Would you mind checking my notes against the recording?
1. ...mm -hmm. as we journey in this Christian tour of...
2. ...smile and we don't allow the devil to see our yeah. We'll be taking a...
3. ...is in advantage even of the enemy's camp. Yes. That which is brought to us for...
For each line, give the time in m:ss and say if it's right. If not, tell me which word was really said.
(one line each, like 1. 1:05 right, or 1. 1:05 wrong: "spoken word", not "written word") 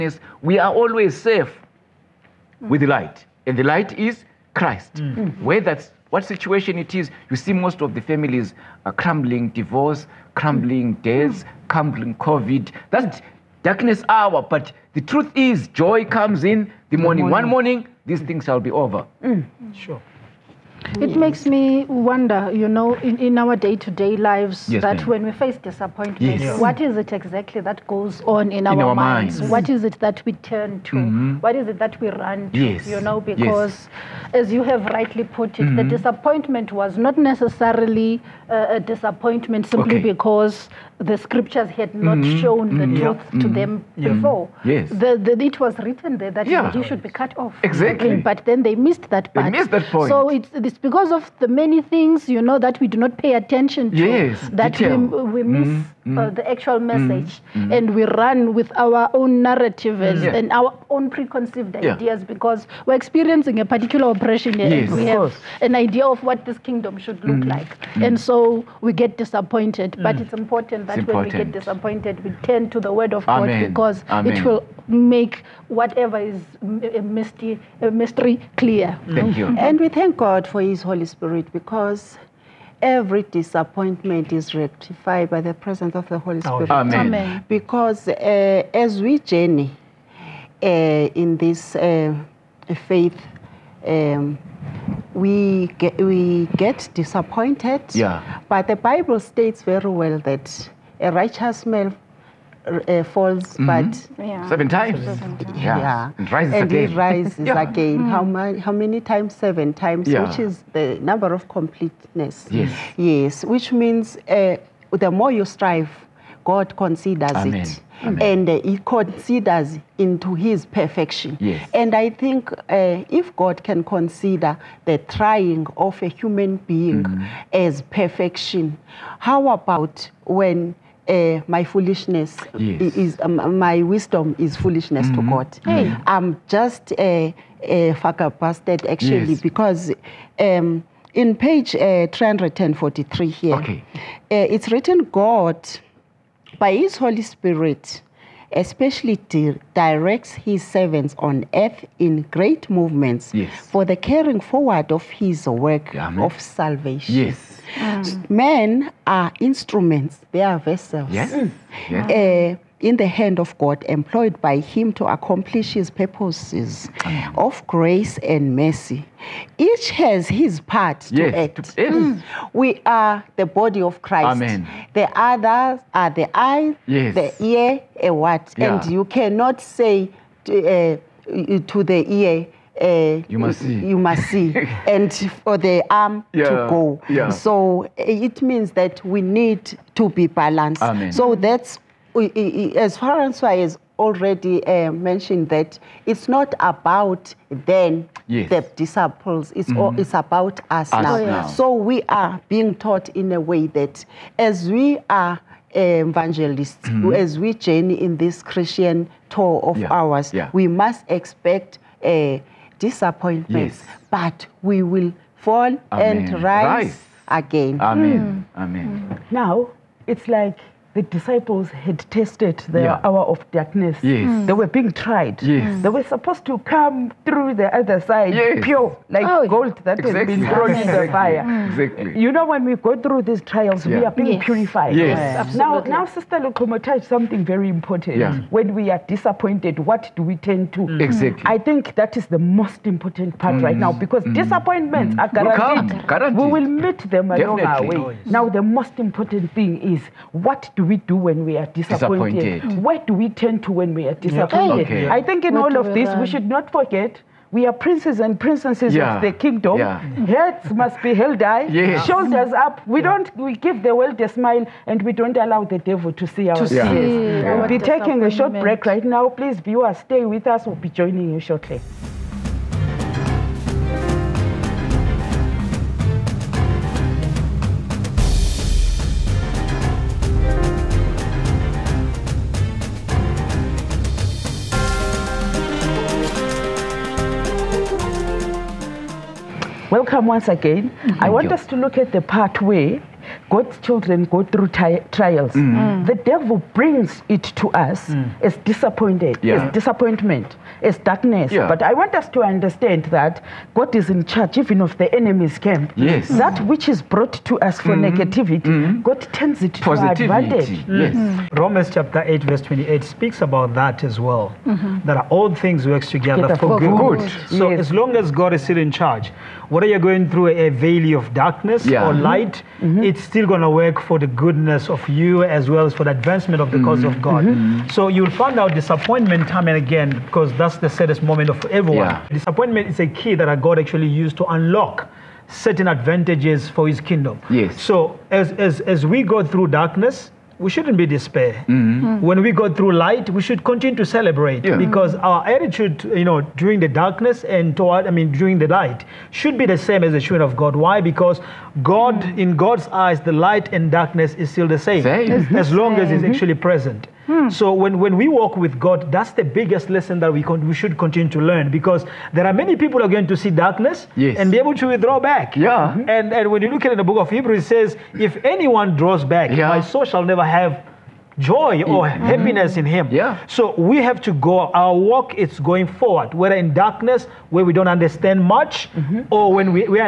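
1. 3:26 right
2. 4:24 right
3. 5:03 wrong: "charge", not "advantage".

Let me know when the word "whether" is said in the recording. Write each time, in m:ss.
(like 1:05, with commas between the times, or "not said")
5:19, 6:16.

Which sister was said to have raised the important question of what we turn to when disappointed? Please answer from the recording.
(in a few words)
Sister Lukoma.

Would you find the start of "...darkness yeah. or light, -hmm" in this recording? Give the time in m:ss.
5:21.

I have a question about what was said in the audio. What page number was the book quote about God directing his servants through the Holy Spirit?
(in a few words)
343.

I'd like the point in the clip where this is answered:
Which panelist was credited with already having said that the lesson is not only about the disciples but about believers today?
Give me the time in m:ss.
3:12.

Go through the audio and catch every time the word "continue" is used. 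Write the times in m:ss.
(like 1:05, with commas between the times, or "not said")
5:43, 6:00.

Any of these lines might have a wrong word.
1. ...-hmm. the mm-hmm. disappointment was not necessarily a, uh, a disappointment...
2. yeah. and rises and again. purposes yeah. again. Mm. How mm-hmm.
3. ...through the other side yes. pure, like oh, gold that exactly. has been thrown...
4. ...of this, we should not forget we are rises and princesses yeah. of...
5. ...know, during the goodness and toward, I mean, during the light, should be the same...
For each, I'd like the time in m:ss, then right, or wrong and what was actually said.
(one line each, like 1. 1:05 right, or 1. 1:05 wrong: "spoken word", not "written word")
1. 0:35 right
2. 1:45 wrong: "rises", not "purposes"
3. 3:47 right
4. 4:15 wrong: "princes", not "rises"
5. 5:46 wrong: "darkness", not "goodness".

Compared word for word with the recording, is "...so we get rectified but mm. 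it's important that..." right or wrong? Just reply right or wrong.
wrong.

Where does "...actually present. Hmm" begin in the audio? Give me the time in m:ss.
5:56.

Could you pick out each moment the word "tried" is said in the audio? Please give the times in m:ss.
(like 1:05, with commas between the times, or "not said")
3:44.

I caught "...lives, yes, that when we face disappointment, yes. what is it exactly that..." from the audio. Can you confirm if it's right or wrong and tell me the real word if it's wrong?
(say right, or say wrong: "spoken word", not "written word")
right.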